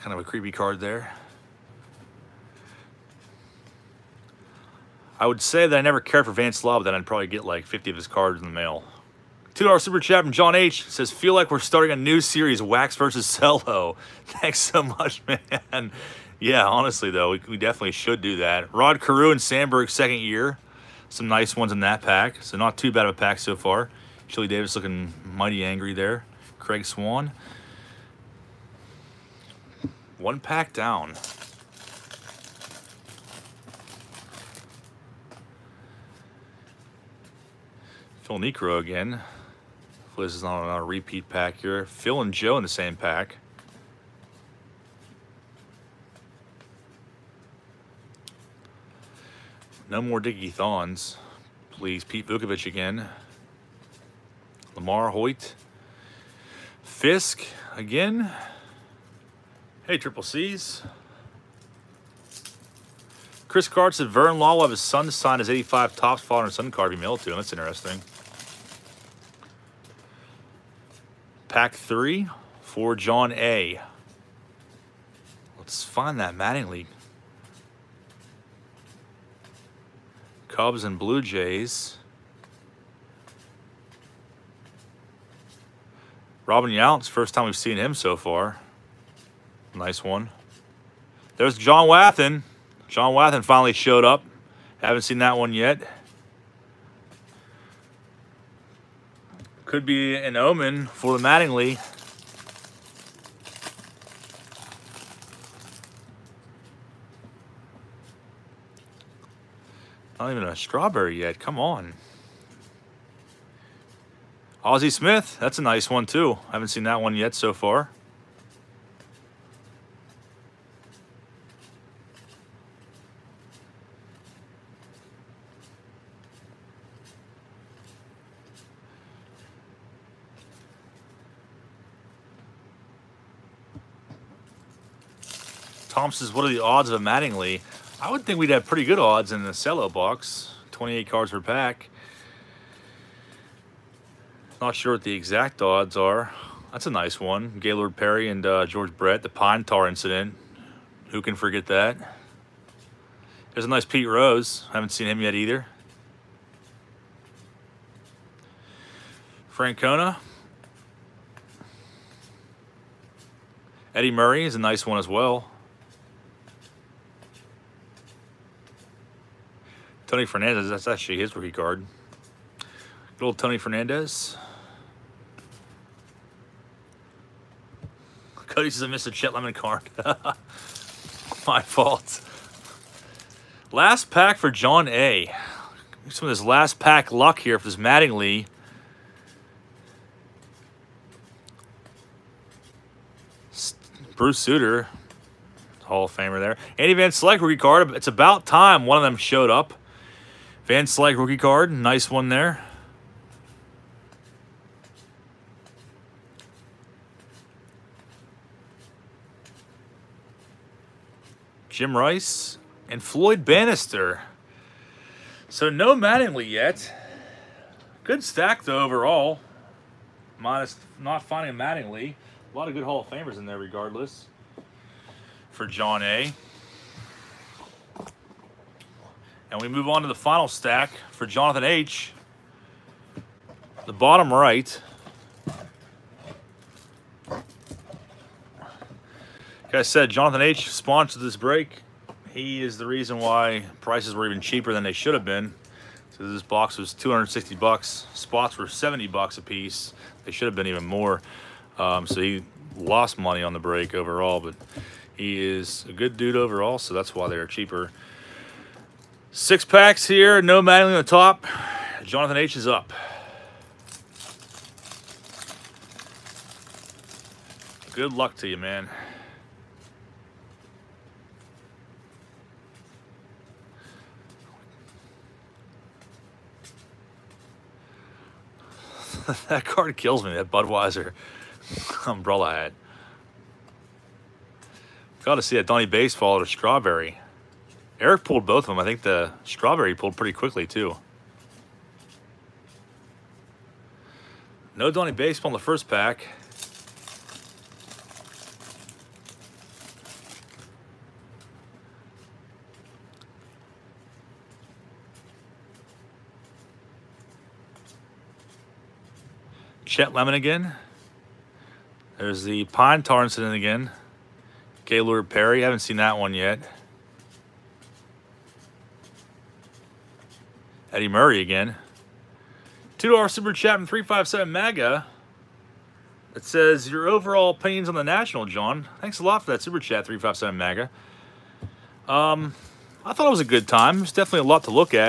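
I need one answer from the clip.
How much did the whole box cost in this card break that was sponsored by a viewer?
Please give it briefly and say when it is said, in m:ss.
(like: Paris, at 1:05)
$260, at 4:06.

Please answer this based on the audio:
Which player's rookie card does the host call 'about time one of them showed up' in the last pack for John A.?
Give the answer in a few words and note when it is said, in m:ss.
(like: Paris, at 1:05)
Andy Van Slyke, at 3:16.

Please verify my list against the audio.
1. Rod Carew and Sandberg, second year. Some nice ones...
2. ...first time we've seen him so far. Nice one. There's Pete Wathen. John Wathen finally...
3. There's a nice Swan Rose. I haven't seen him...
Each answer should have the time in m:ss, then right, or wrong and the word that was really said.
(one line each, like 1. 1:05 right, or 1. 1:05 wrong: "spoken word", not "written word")
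1. 0:18 right
2. 1:27 wrong: "John", not "Pete"
3. 2:33 wrong: "Pete", not "Swan".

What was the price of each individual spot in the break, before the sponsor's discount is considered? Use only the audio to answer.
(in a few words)
$70.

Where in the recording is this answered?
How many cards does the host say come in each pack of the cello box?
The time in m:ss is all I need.
2:20.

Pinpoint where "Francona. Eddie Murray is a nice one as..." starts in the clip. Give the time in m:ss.
2:39.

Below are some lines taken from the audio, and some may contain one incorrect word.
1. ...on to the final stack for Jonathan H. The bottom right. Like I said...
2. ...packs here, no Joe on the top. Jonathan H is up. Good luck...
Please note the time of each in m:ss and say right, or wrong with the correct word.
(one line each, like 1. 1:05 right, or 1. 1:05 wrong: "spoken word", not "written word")
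1. 3:49 right
2. 4:19 wrong: "Mattingly", not "Joe".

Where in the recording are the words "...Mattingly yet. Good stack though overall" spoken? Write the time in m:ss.
3:35.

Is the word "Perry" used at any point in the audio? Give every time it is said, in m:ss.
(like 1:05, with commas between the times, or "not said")
2:27, 5:15.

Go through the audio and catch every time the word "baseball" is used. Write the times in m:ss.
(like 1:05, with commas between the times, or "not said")
4:45, 4:55.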